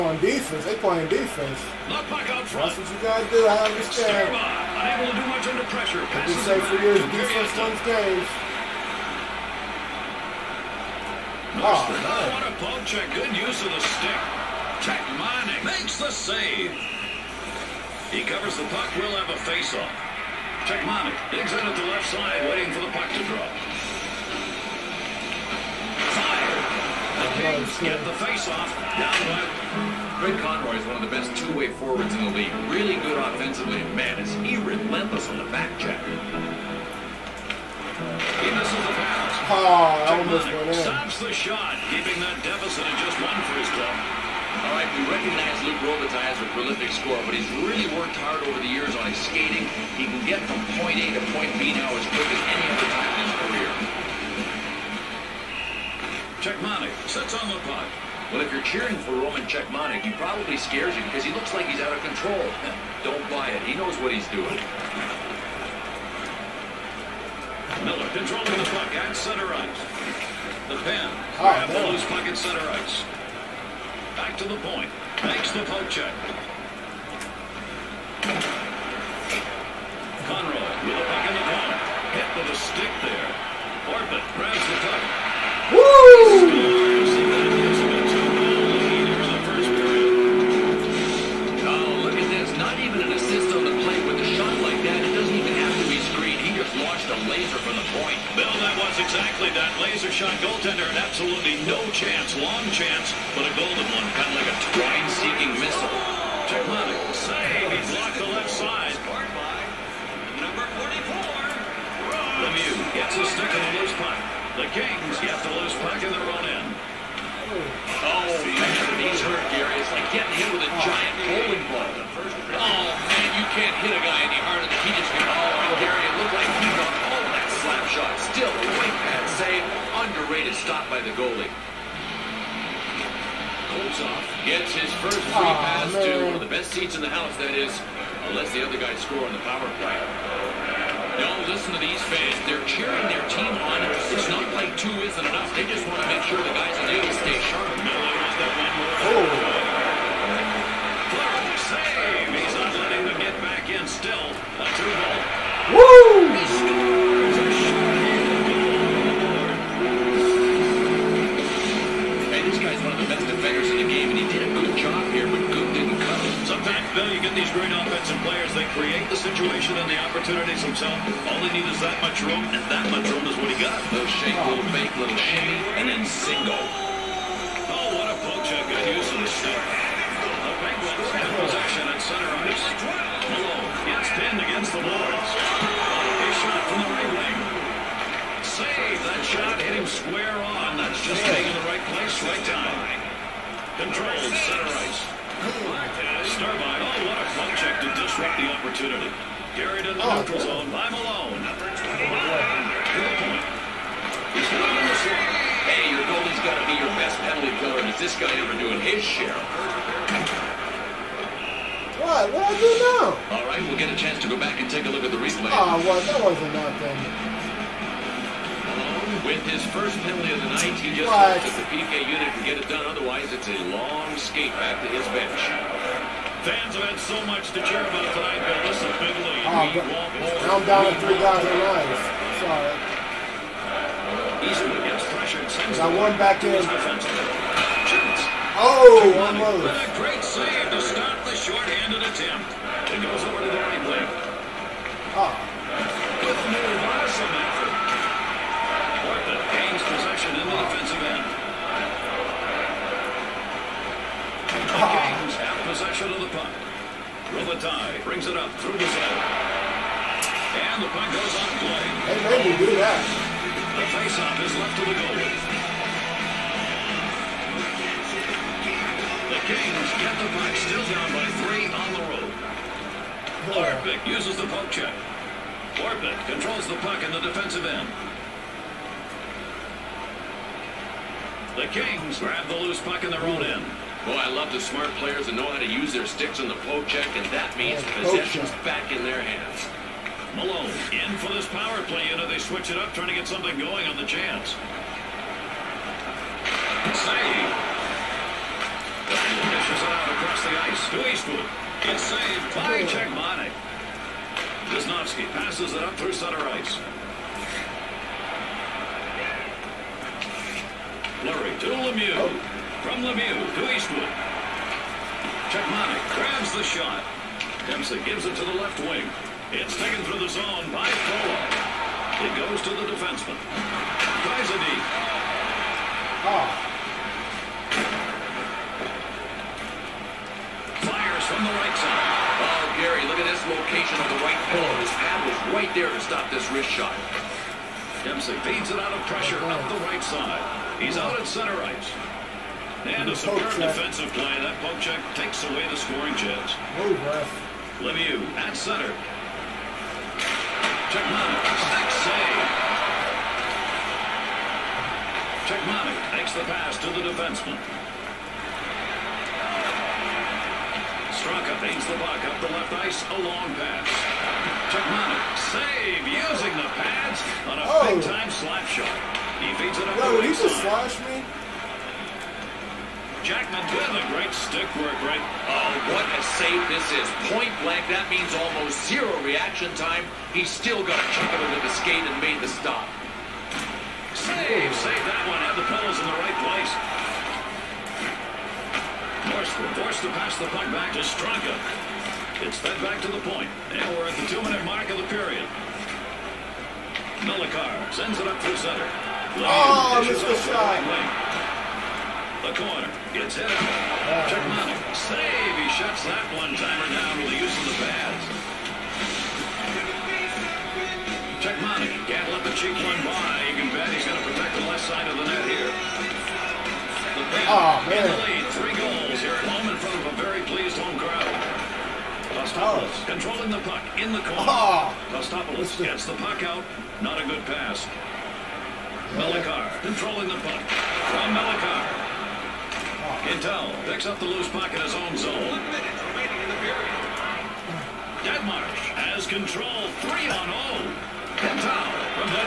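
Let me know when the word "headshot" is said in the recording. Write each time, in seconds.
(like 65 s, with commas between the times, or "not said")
not said.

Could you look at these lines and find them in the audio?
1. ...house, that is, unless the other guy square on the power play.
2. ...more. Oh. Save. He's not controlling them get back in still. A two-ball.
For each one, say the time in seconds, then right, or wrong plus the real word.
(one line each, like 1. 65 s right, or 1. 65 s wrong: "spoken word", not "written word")
1. 137 s wrong: "score", not "square"
2. 149 s wrong: "letting", not "controlling".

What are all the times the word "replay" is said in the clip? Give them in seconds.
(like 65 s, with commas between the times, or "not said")
215 s.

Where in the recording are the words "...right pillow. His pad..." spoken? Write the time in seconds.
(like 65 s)
334 s.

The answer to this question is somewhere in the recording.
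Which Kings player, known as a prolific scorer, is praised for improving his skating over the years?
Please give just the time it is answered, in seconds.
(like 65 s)
45 s.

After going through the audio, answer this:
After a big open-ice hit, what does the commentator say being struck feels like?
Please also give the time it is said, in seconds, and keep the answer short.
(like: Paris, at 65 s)
a giant bowling ball, at 120 s.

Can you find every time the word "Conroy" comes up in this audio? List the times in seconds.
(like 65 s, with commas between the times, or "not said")
30 s, 80 s.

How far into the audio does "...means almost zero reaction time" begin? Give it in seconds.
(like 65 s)
378 s.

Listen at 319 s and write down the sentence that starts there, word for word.
It's taken through the zone by Polo.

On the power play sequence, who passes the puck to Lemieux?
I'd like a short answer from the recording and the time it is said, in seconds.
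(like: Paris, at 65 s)
Fleury, at 311 s.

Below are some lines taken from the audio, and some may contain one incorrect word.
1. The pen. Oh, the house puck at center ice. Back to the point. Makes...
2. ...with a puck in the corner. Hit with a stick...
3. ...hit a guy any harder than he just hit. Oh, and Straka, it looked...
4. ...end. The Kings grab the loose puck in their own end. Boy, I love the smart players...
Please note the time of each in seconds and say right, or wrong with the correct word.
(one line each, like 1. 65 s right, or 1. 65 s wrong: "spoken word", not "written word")
1. 70 s wrong: "loose", not "house"
2. 80 s right
3. 123 s wrong: "Gary", not "Straka"
4. 277 s right.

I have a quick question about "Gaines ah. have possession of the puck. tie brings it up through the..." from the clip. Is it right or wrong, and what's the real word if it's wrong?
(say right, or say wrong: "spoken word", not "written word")
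right.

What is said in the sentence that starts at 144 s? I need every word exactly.
It's not like two isn't enough.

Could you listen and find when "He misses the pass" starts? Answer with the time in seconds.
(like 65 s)
38 s.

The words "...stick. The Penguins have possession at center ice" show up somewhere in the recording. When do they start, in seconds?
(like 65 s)
179 s.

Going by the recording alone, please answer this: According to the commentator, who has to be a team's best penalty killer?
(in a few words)
your goalie.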